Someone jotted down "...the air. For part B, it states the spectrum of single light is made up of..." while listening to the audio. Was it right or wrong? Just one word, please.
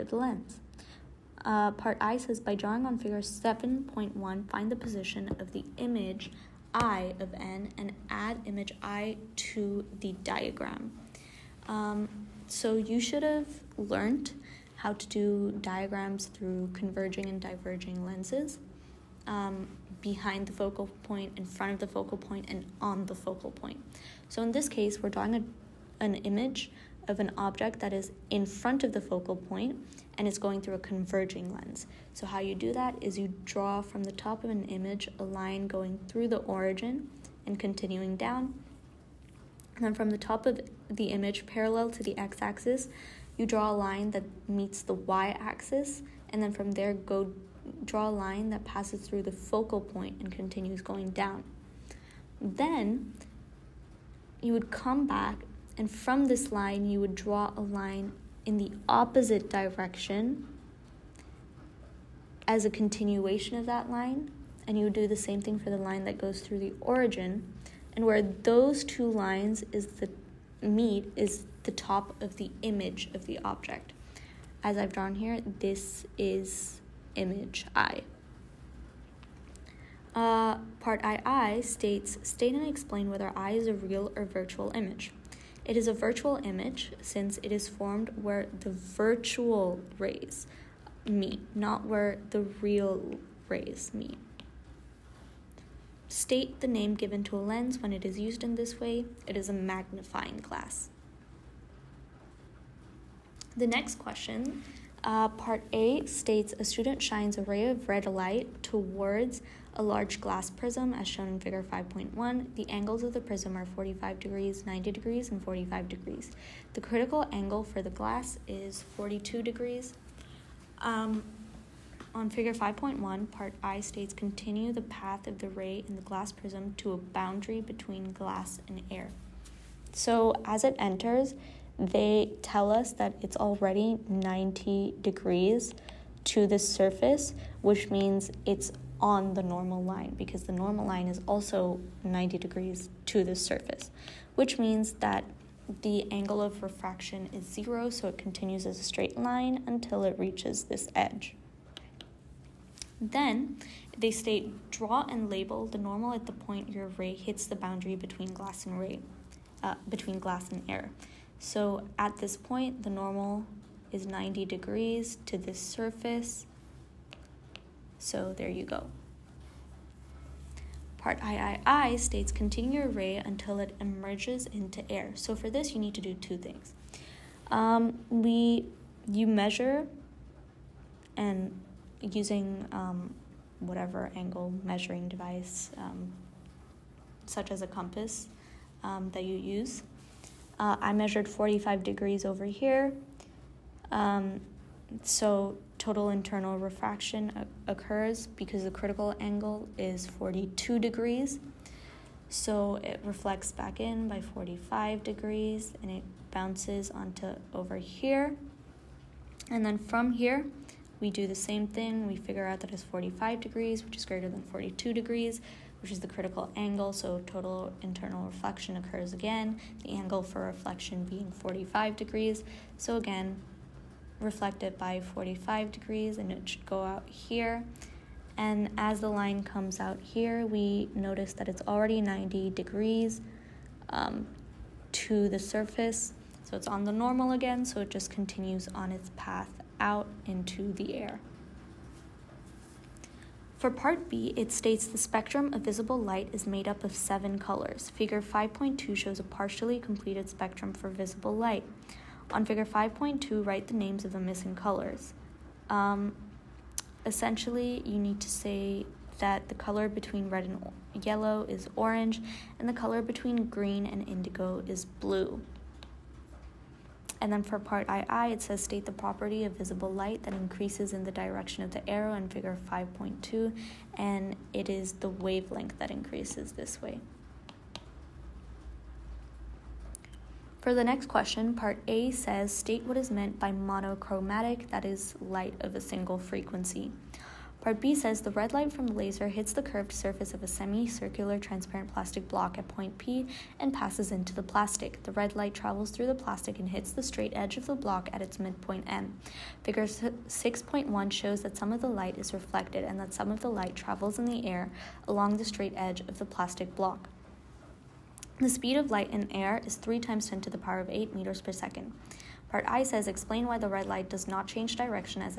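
wrong.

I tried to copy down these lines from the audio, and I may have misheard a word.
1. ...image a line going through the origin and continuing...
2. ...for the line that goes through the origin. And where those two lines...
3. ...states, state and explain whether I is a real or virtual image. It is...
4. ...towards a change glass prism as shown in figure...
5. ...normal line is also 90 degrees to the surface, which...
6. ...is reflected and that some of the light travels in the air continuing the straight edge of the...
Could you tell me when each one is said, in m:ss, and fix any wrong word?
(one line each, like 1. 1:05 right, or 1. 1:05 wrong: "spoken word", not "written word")
1. 0:34 right
2. 1:05 right
3. 1:21 right
4. 1:48 wrong: "large", not "change"
5. 2:20 right
6. 5:02 wrong: "along", not "continuing".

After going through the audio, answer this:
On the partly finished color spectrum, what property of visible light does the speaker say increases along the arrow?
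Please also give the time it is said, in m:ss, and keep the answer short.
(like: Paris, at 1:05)
Wavelength, at 4:35.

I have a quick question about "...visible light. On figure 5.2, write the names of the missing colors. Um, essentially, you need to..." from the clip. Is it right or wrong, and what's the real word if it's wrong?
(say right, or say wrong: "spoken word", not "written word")
right.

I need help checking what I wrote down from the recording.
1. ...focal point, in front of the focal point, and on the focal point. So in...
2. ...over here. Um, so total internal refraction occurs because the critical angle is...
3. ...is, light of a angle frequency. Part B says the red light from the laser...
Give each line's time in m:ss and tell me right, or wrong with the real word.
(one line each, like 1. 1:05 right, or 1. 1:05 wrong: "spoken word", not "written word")
1. 0:20 right
2. 3:12 right
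3. 4:44 wrong: "single", not "angle".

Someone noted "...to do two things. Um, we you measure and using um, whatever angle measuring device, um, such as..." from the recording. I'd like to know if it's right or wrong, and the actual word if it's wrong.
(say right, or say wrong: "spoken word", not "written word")
right.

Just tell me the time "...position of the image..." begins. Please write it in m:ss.
0:04.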